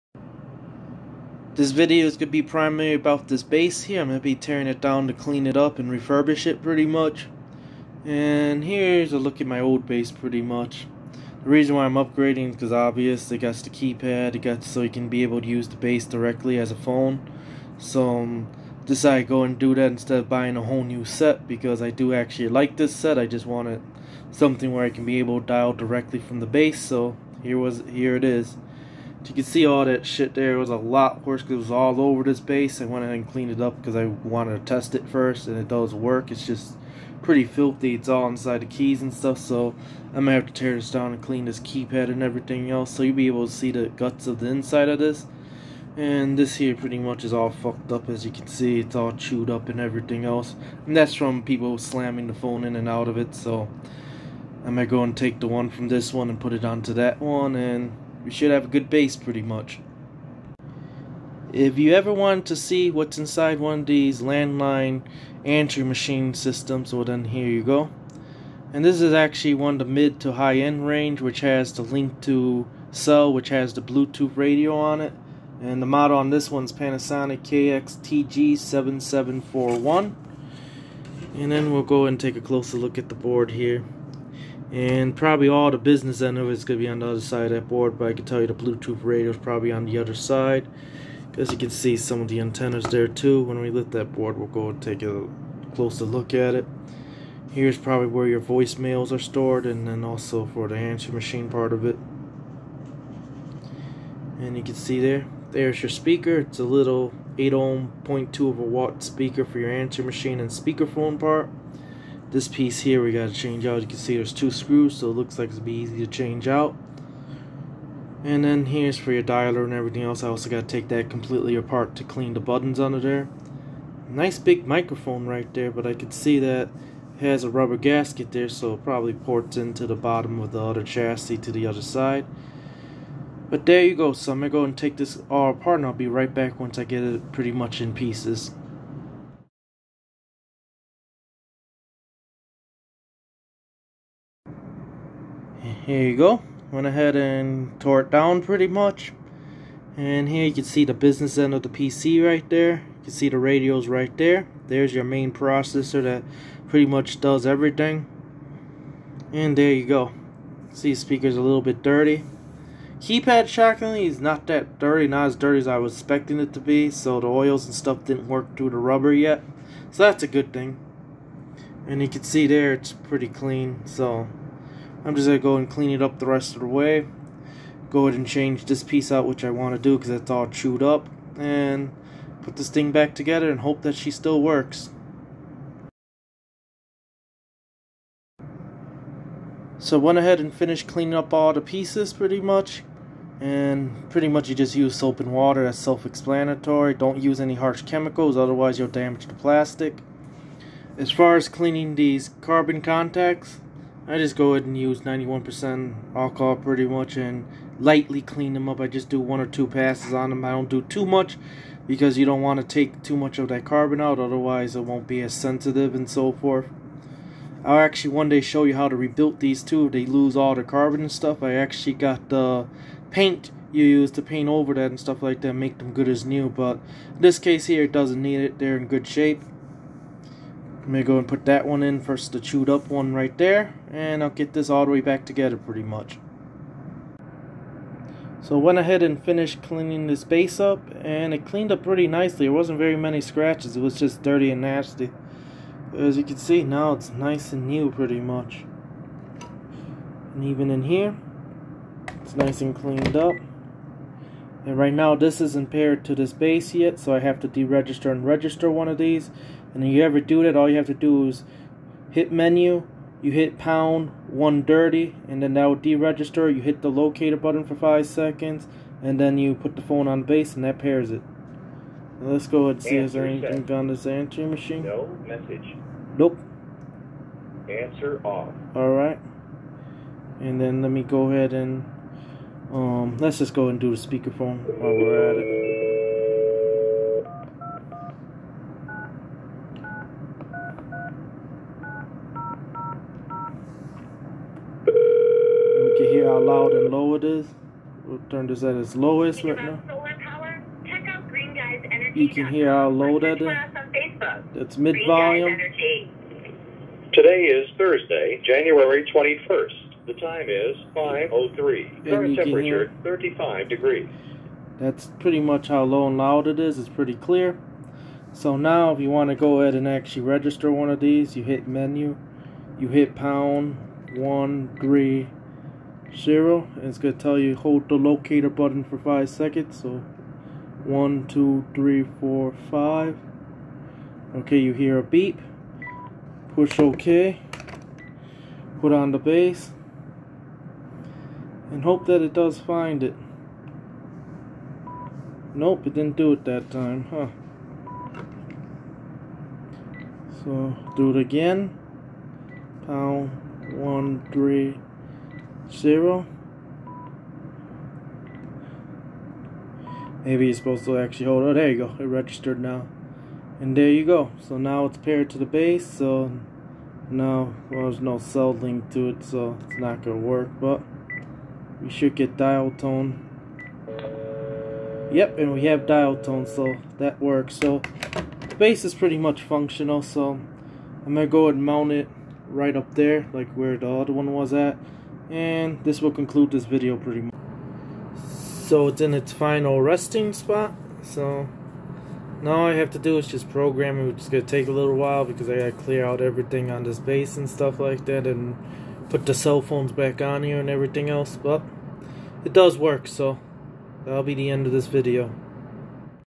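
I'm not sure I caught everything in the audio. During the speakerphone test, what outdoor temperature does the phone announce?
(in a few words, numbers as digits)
35 degrees.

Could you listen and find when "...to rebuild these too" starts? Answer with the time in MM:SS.
03:38.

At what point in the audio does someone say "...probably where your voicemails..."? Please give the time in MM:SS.
01:37.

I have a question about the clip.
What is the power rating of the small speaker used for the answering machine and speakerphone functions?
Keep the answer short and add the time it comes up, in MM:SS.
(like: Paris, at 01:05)
0.2 watt, at 01:48.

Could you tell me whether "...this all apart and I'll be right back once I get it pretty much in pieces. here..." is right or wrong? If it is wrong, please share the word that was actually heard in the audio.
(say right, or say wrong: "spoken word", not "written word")
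right.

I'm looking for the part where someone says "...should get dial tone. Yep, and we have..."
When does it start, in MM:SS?
06:11.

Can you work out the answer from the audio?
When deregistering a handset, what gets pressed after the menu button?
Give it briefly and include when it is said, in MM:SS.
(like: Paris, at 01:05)
pound 130, at 04:23.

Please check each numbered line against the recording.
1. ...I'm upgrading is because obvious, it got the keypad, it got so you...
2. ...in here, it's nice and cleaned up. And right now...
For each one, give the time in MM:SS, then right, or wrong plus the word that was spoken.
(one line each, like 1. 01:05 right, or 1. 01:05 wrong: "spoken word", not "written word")
1. 00:11 right
2. 04:10 right.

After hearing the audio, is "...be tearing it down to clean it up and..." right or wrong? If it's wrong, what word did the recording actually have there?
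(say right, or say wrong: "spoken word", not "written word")
right.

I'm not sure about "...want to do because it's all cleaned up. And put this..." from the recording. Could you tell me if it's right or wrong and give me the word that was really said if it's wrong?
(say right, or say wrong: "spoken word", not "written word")
wrong: "chewed", not "cleaned".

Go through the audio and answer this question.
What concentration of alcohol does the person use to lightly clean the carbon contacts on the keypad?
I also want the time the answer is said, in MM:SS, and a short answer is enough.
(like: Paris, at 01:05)
91%, at 03:25.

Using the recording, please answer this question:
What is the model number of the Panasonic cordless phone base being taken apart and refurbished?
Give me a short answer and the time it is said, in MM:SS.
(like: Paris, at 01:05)
KXTG7741, at 01:17.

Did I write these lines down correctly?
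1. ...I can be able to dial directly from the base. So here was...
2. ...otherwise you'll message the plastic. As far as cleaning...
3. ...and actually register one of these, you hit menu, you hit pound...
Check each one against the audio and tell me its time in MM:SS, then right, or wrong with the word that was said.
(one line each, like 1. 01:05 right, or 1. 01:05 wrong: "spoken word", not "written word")
1. 00:24 right
2. 03:18 wrong: "damage", not "message"
3. 05:19 right.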